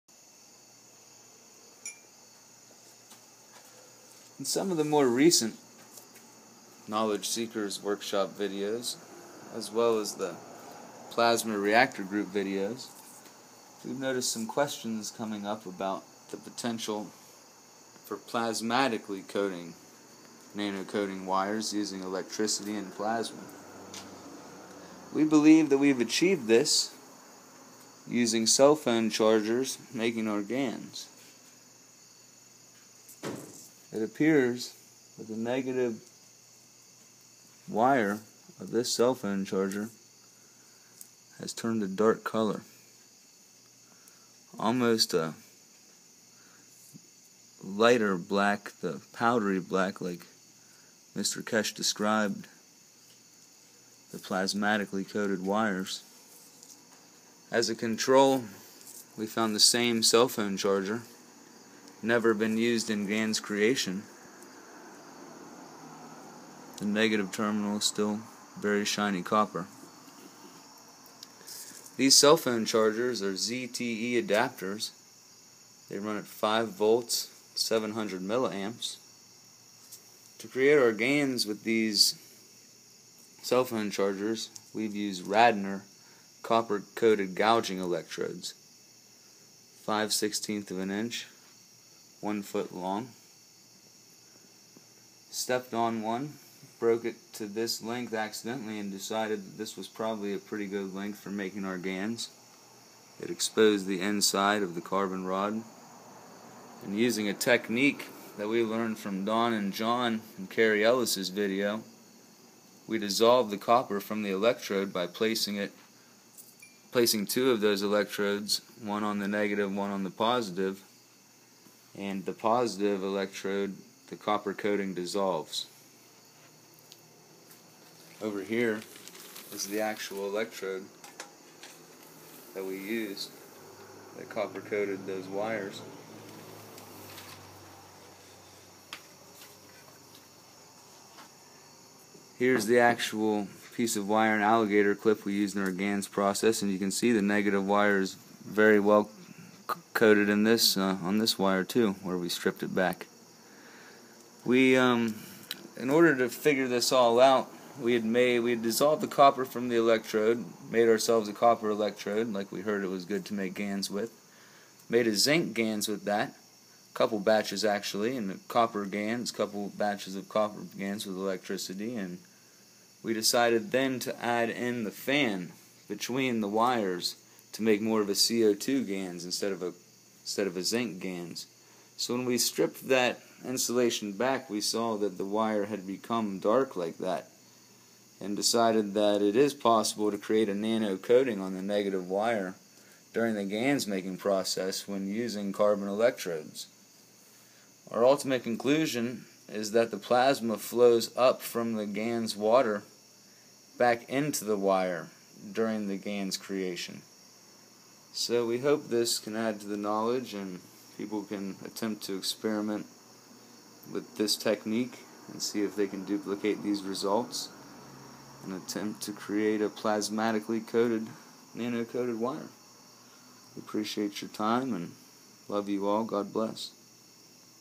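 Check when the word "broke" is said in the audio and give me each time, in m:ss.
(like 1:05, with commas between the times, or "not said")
1:36.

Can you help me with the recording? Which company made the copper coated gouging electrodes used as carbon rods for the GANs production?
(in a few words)
Radnor.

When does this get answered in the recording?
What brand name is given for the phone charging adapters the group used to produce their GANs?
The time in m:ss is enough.
1:13.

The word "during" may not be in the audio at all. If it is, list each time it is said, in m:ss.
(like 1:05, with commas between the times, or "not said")
3:13, 3:25.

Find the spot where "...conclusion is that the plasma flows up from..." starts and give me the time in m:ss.
3:18.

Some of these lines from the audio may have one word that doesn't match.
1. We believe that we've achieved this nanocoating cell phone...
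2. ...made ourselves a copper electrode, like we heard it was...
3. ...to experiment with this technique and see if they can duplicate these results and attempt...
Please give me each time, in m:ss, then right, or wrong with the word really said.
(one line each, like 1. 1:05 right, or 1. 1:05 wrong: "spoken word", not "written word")
1. 0:25 wrong: "using", not "nanocoating"
2. 2:40 right
3. 3:32 right.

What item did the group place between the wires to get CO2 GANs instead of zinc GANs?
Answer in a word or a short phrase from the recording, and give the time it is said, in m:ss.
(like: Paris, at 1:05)
the fan, at 2:54.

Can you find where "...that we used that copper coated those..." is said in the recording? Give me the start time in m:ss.
2:12.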